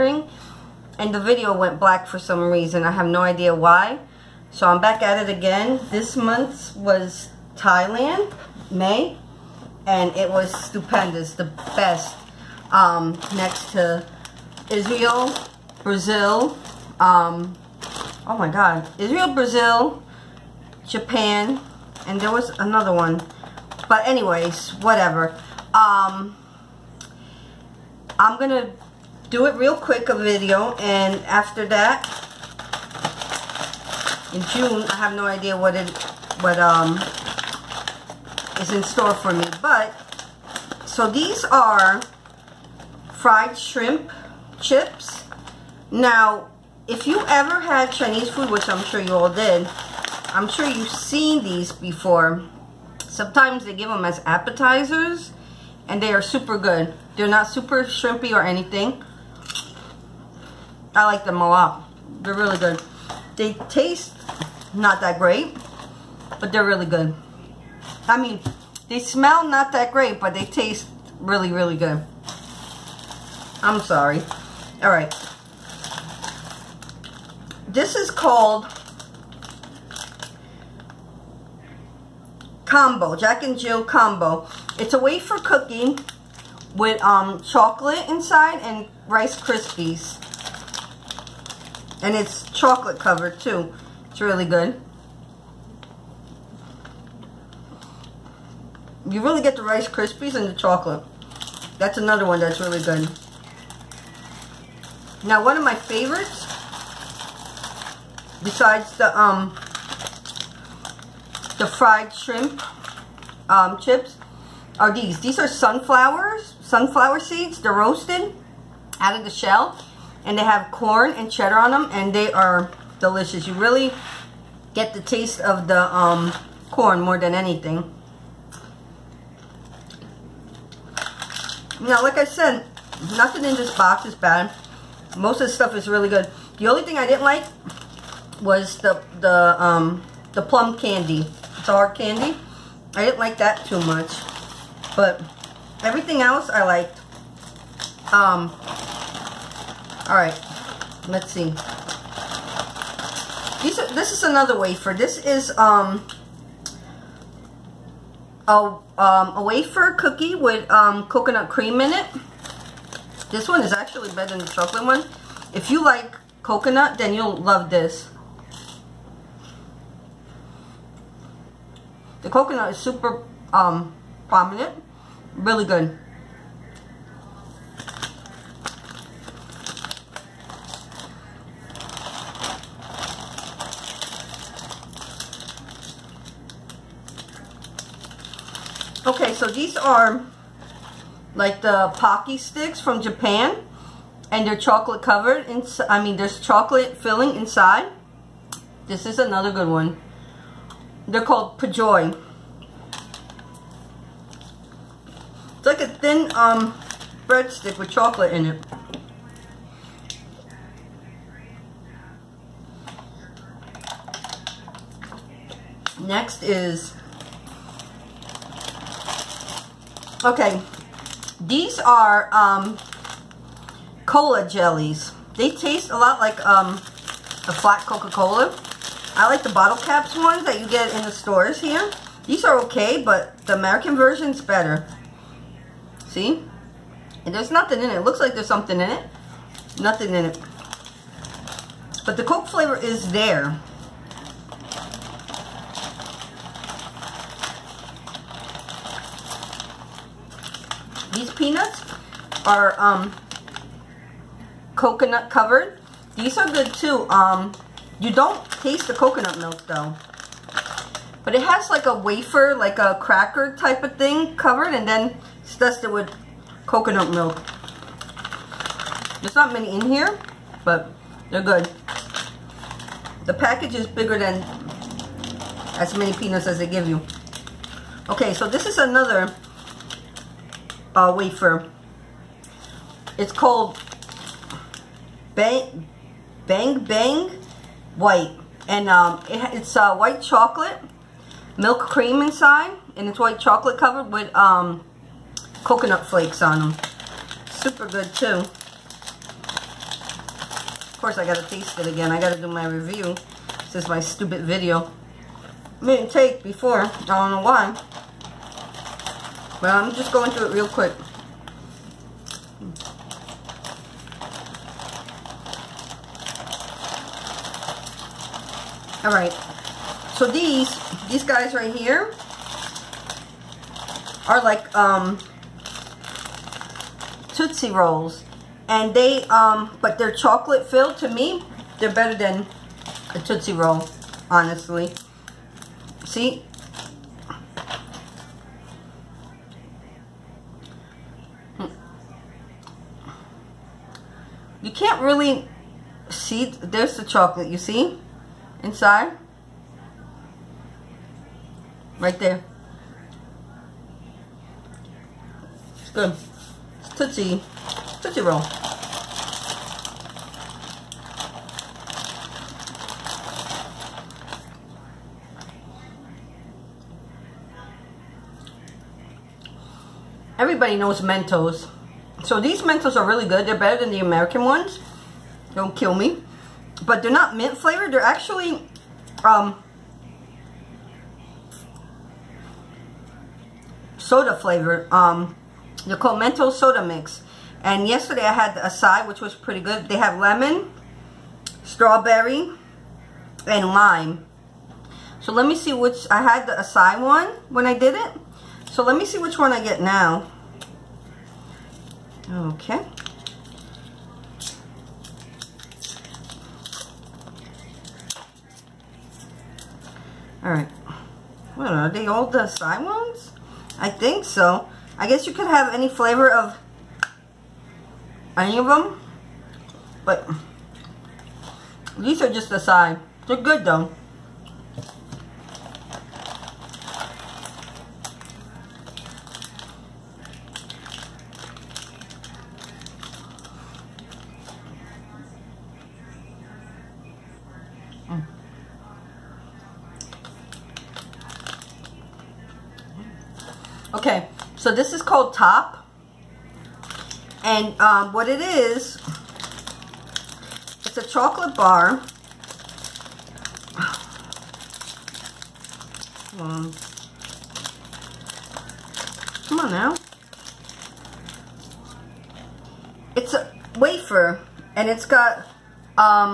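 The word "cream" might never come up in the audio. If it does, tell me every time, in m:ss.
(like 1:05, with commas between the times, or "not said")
2:41, 4:51.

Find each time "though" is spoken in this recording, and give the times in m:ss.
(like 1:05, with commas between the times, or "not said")
4:19, 7:03.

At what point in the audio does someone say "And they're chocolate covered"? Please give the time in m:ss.
3:14.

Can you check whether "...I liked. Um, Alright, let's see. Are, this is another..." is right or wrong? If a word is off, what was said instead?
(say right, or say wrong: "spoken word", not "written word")
right.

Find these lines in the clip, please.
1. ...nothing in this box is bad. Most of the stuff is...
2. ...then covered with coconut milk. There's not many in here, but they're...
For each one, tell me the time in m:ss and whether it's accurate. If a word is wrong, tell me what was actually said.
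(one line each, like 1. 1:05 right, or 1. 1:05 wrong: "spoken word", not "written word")
1. 2:13 right
2. 4:24 wrong: "dusted", not "covered".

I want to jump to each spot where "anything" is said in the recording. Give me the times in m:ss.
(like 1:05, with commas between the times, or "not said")
0:58, 2:07.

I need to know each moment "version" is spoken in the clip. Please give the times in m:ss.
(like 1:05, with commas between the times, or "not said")
3:53.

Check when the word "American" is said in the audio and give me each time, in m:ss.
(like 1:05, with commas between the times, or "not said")
3:53, 6:13.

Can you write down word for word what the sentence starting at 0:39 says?
But, so these are fried shrimp chips.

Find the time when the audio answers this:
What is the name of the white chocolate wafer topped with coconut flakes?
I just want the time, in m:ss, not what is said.
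4:45.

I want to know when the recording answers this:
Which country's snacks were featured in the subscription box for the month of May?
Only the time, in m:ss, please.
0:07.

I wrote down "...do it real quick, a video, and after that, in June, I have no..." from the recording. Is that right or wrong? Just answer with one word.
right.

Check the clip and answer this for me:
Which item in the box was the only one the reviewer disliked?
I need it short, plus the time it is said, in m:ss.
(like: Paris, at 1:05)
plum candy star candy, at 2:20.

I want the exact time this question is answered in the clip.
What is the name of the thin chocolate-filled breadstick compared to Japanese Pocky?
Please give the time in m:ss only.
3:21.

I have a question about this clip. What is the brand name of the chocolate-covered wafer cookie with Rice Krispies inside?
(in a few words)
Jack and Jill.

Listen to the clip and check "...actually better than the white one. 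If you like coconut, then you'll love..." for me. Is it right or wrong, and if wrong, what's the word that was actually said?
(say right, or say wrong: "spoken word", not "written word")
wrong: "chocolate", not "white".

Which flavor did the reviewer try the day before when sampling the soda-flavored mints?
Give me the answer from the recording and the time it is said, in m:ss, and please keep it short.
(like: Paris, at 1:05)
acai, at 6:36.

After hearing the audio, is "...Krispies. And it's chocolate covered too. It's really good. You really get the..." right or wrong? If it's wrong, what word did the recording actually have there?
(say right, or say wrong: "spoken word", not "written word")
right.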